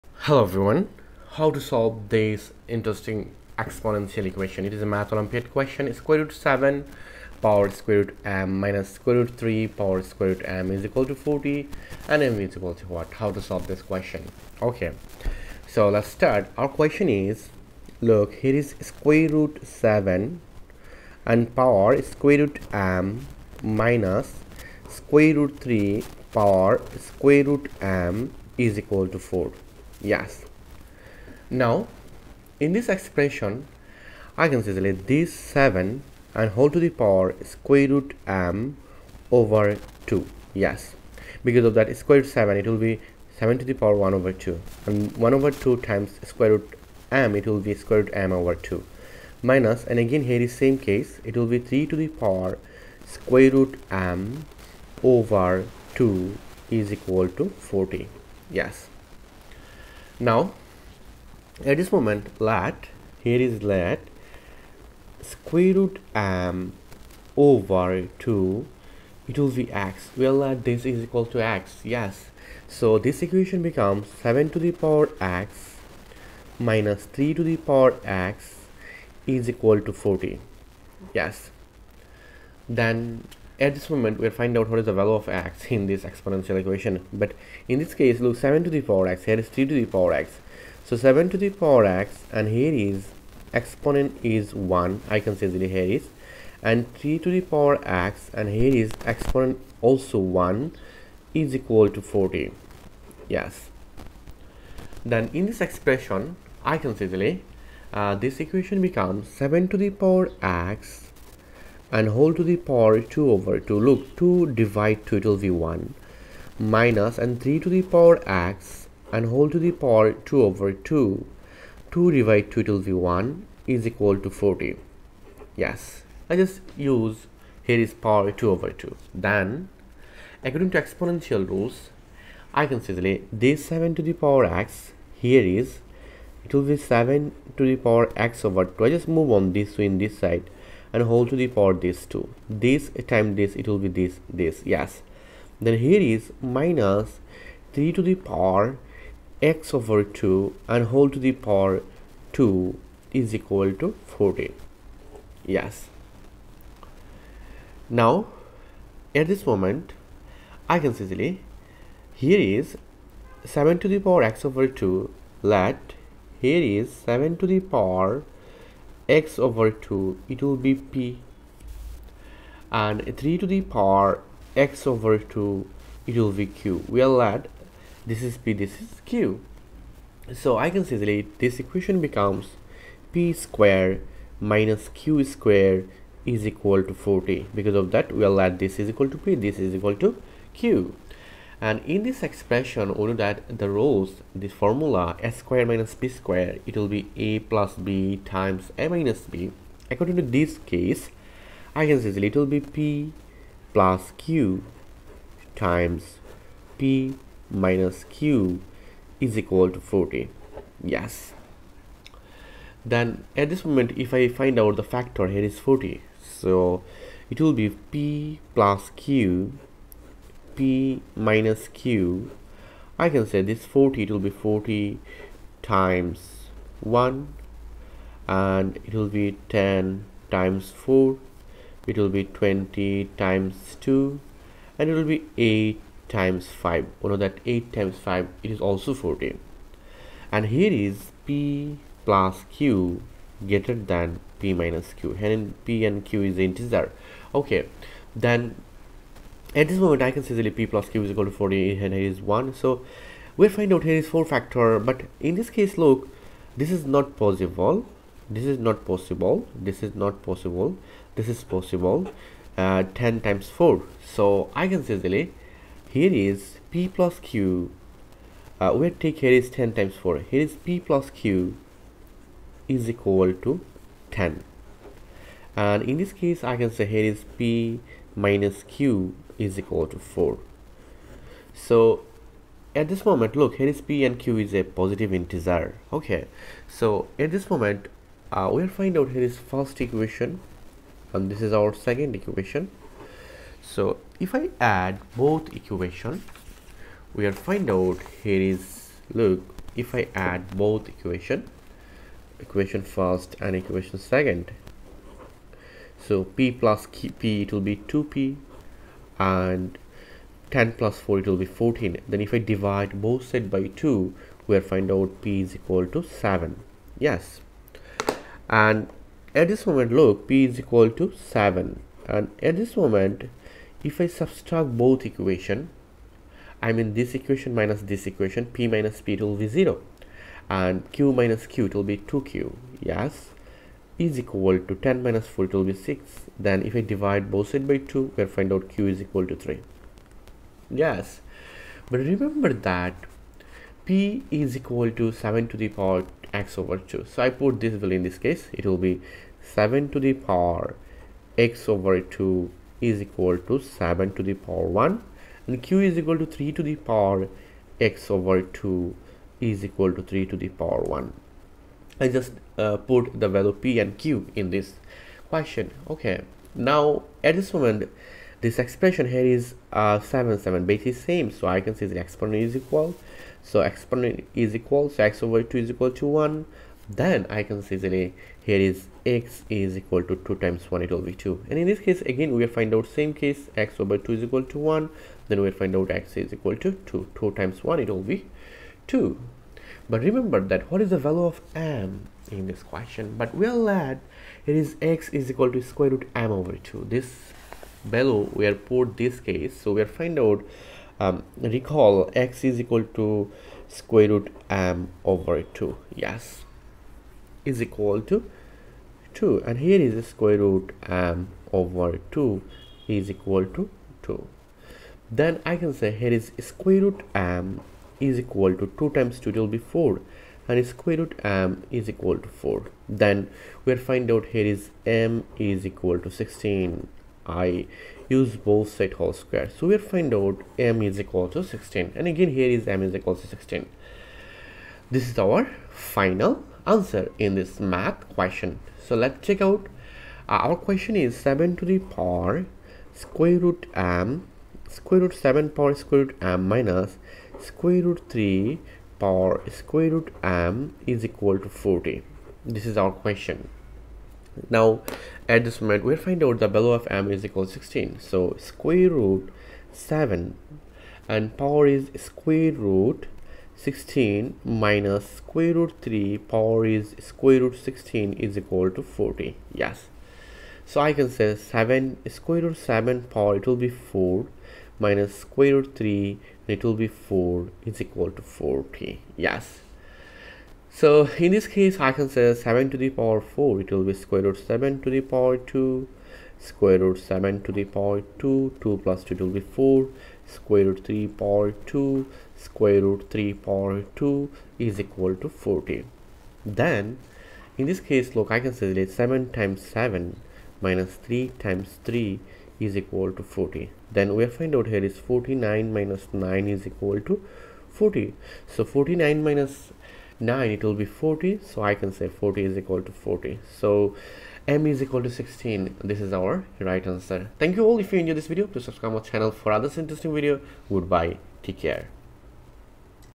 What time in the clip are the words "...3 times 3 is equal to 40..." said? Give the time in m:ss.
8:21.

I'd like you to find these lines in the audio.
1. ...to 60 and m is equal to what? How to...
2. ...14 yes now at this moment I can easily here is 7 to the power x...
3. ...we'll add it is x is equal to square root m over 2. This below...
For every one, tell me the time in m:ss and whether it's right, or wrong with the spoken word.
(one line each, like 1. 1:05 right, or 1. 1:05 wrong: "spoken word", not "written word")
1. 0:11 wrong: "40", not "60"
2. 2:34 right
3. 6:33 right.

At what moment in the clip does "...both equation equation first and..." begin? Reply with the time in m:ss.
5:00.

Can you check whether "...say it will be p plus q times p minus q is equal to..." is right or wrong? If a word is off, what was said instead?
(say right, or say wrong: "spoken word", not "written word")
right.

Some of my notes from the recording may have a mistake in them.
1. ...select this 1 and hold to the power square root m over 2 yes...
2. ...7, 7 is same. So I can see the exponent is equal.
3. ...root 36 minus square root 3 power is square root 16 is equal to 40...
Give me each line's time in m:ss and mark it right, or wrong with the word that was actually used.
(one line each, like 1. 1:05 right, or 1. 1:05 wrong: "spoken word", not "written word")
1. 0:34 wrong: "7", not "1"
2. 6:09 right
3. 7:42 wrong: "16", not "36".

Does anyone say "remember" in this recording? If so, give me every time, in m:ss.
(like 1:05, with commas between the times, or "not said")
5:42, 6:30.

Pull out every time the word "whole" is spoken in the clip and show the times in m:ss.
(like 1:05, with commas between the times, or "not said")
1:59, 2:30, 7:08.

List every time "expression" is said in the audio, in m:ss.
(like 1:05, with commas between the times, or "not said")
0:32, 1:45, 3:12, 6:08.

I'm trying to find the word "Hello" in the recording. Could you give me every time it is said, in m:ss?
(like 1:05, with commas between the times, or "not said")
0:00.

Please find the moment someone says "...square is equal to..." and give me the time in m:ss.
3:05.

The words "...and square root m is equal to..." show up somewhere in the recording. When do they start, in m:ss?
7:00.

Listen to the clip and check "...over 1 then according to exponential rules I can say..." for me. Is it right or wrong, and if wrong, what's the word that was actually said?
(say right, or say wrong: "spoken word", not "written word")
wrong: "2", not "1".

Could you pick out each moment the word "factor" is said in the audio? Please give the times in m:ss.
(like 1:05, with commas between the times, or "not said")
3:34, 4:14.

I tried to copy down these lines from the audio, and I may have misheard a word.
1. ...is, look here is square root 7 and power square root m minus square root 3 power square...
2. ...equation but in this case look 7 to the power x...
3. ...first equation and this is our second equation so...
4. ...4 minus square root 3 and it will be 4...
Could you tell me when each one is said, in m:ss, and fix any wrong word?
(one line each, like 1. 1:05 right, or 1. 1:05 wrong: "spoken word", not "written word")
1. 0:17 right
2. 1:26 right
3. 4:49 right
4. 7:53 right.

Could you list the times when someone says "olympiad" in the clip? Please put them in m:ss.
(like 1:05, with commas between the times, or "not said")
0:05.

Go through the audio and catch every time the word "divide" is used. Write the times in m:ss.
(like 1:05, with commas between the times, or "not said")
1:54, 2:02, 5:12, 5:36.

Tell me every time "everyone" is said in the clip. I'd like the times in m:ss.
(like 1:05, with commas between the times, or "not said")
0:00.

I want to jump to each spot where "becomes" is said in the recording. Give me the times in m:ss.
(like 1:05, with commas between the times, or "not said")
1:13, 1:48, 3:02.